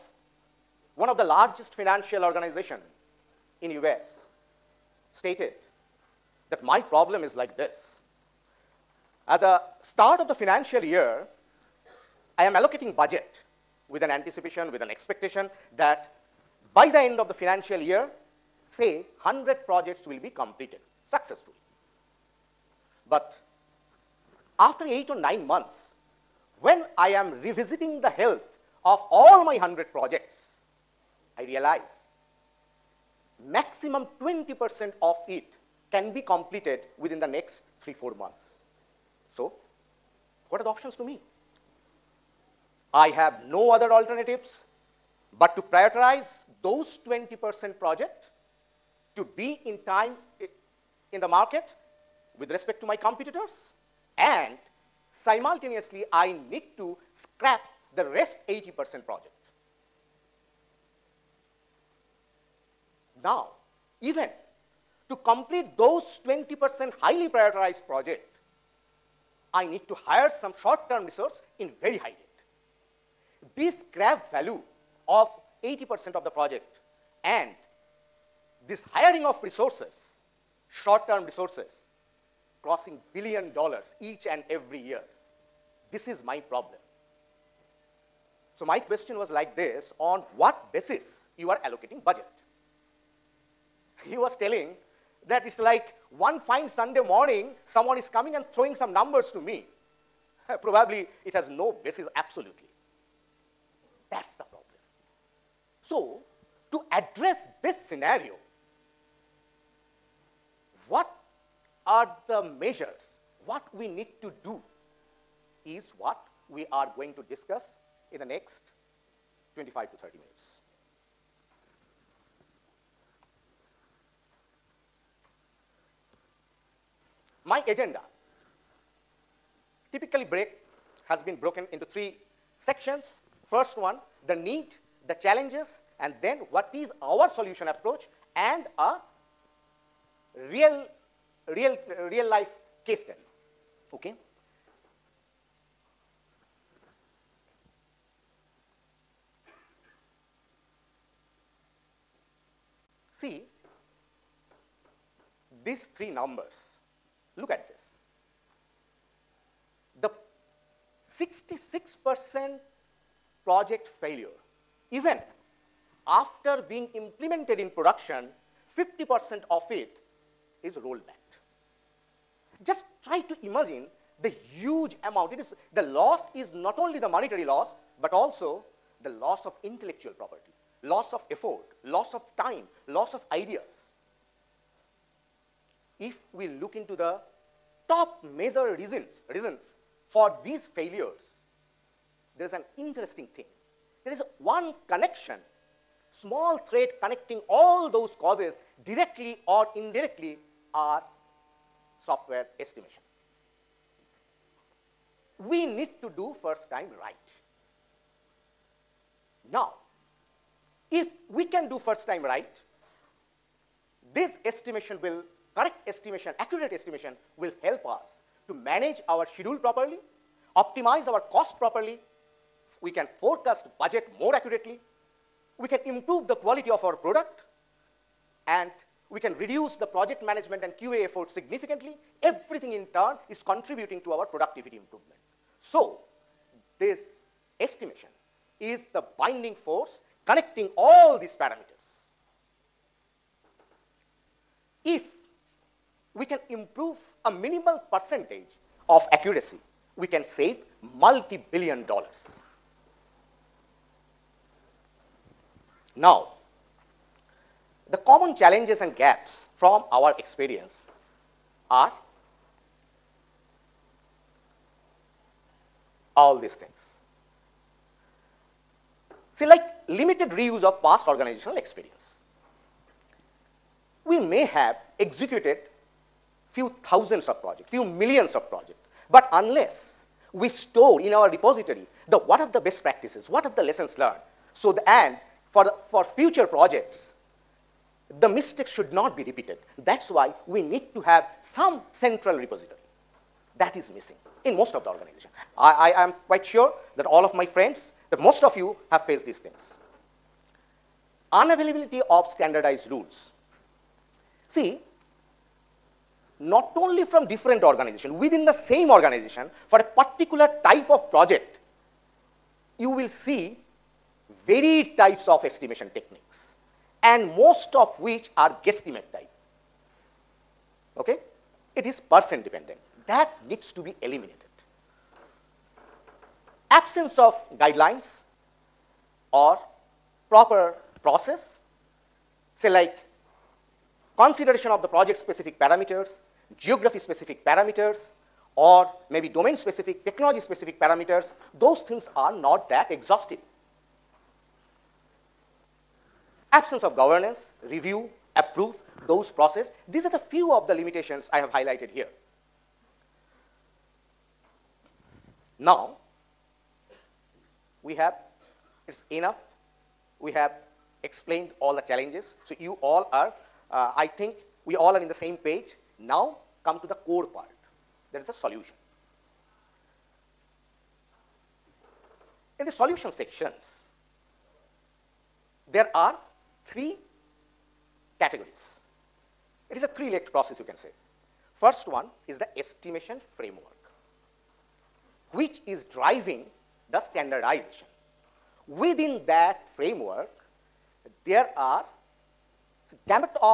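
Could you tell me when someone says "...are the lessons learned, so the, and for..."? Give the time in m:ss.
4:43.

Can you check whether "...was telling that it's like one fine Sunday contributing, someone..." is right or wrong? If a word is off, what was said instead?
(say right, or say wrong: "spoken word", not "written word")
wrong: "morning", not "contributing".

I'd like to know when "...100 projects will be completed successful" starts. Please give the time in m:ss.
0:19.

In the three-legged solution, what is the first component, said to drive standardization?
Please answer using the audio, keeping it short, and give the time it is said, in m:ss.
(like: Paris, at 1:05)
estimation framework, at 6:22.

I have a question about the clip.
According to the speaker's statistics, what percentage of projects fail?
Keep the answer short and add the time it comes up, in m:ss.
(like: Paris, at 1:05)
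66 percent, at 2:41.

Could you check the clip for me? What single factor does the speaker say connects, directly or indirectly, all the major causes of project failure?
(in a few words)
software estimation.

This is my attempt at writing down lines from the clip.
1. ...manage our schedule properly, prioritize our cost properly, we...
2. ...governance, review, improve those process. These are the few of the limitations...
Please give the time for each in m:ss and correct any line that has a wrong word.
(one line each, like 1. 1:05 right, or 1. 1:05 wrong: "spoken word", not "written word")
1. 3:38 wrong: "optimize", not "prioritize"
2. 5:46 wrong: "approve", not "improve".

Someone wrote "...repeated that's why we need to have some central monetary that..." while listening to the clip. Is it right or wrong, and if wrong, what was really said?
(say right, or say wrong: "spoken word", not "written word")
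wrong: "repository", not "monetary".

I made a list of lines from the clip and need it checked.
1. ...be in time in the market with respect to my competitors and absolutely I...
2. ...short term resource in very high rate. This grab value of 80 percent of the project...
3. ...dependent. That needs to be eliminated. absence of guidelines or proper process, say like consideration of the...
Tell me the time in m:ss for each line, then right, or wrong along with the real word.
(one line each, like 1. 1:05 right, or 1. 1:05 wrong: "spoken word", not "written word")
1. 0:49 wrong: "simultaneously", not "absolutely"
2. 1:10 right
3. 5:22 right.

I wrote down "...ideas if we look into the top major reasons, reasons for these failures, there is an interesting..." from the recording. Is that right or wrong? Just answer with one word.
right.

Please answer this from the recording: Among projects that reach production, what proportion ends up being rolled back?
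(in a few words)
50 percent.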